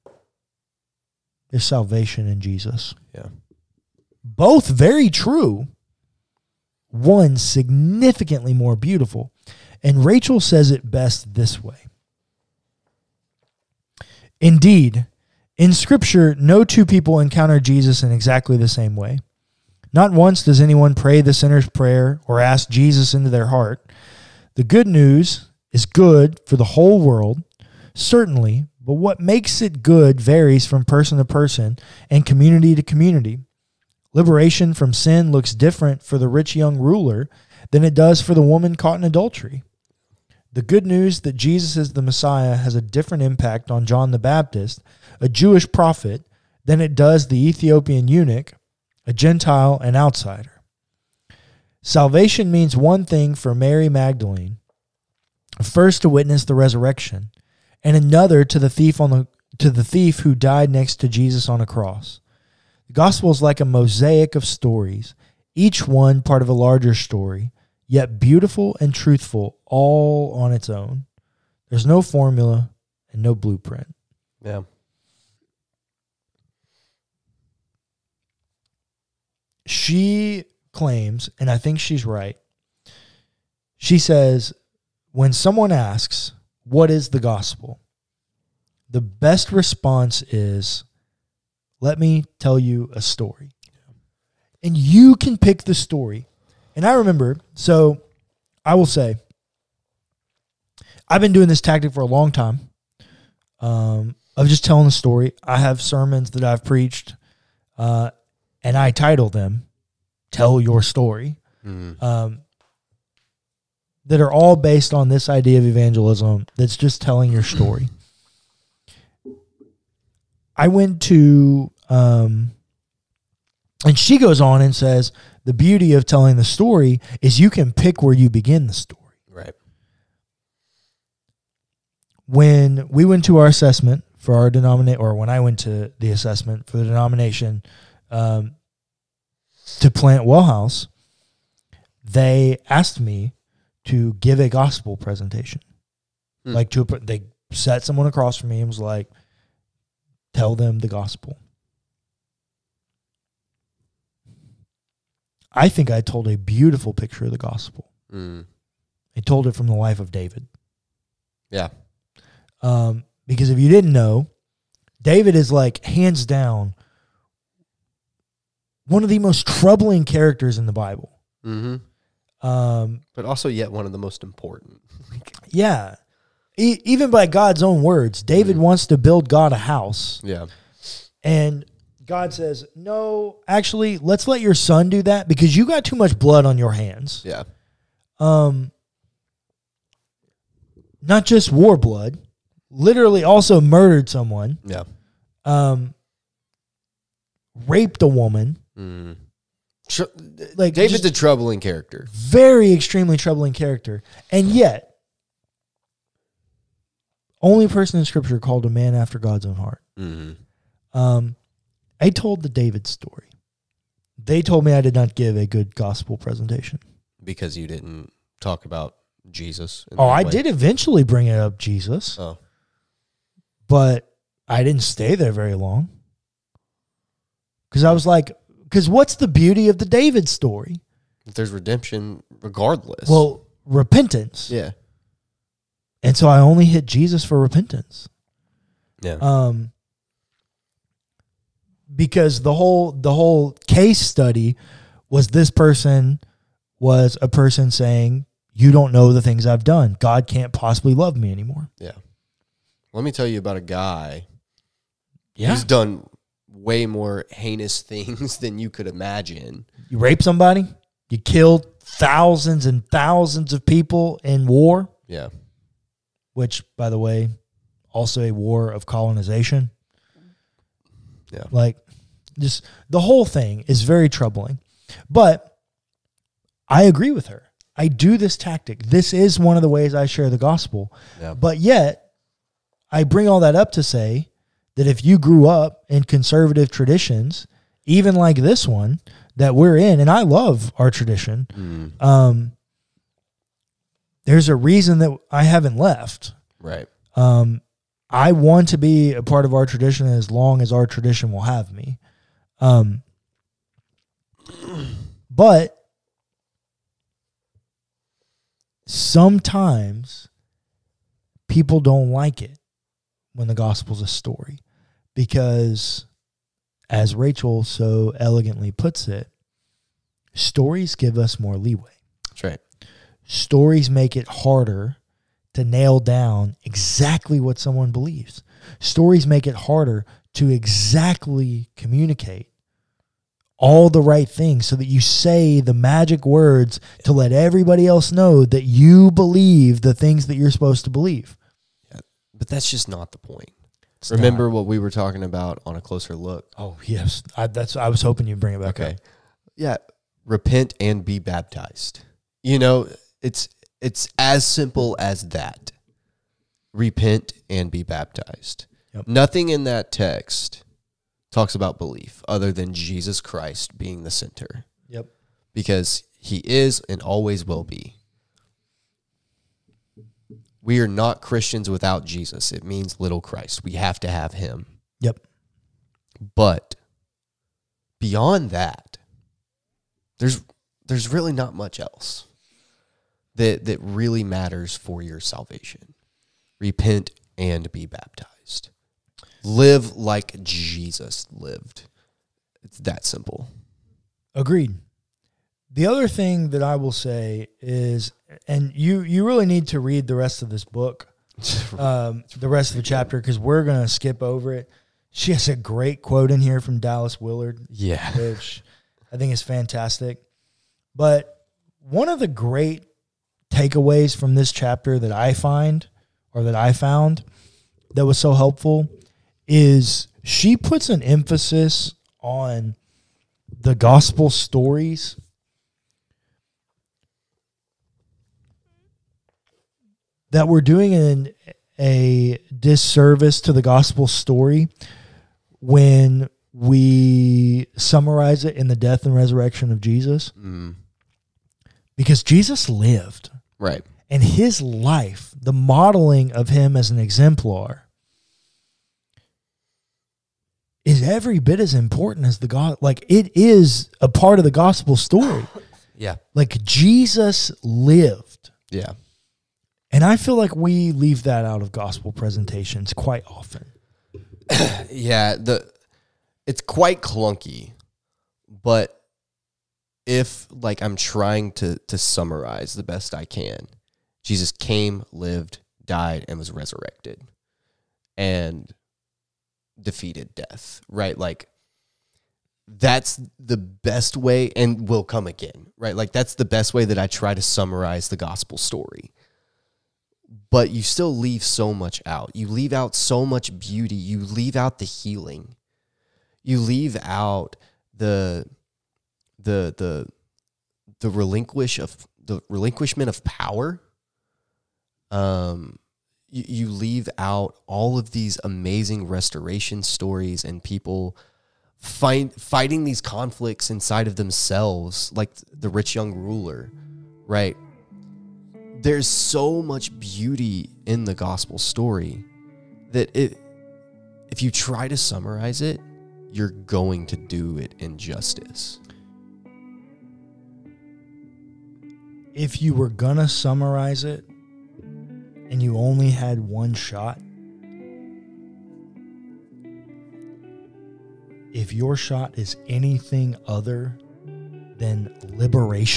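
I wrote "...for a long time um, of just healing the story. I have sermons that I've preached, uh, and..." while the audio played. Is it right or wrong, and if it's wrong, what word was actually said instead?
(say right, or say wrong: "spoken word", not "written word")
wrong: "telling", not "healing".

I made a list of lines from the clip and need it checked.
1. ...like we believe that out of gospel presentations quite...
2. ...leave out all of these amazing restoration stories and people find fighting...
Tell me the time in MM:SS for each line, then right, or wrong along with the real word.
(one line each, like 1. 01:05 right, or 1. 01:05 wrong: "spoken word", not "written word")
1. 07:40 wrong: "leave", not "believe"
2. 08:26 right.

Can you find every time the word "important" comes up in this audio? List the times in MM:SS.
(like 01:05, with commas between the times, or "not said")
02:54, 07:31.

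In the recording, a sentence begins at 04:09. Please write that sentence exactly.
God can't possibly love me anymore.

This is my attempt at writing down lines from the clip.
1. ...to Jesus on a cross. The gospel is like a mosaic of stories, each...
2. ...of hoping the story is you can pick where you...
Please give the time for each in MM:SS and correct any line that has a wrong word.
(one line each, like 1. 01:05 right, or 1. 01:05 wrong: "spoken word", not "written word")
1. 01:00 right
2. 02:05 wrong: "telling", not "hoping".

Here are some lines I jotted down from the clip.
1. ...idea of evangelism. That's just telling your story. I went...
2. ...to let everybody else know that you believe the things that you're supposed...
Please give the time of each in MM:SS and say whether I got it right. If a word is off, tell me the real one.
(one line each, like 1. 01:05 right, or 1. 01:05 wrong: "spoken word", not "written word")
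1. 01:55 right
2. 05:37 right.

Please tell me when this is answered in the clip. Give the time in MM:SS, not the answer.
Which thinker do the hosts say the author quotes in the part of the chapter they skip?
06:46.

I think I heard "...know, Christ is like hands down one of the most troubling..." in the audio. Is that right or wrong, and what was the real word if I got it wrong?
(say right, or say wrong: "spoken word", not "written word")
wrong: "David", not "Christ".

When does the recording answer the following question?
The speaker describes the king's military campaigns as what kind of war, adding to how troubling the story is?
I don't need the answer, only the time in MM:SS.
04:28.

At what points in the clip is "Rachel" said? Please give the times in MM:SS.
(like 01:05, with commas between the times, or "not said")
00:10, 05:17.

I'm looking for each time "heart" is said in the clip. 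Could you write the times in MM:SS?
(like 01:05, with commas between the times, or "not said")
00:23, 03:29.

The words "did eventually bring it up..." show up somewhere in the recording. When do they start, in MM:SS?
03:40.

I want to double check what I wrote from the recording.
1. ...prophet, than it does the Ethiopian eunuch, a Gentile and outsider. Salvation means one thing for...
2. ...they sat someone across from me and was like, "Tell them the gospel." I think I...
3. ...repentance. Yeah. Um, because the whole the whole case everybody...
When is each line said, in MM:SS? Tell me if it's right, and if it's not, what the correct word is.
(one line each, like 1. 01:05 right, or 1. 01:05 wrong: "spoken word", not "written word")
1. 00:45 right
2. 02:26 right
3. 03:57 wrong: "study", not "everybody".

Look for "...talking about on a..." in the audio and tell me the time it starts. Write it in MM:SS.
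05:44.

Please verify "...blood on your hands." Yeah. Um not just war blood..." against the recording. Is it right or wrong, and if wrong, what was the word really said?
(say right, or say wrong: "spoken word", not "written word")
right.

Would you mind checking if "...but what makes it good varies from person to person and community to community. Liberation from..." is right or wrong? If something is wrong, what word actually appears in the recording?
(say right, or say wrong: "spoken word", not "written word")
right.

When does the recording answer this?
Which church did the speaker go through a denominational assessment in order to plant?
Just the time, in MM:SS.
02:20.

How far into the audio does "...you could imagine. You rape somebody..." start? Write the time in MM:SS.
04:18.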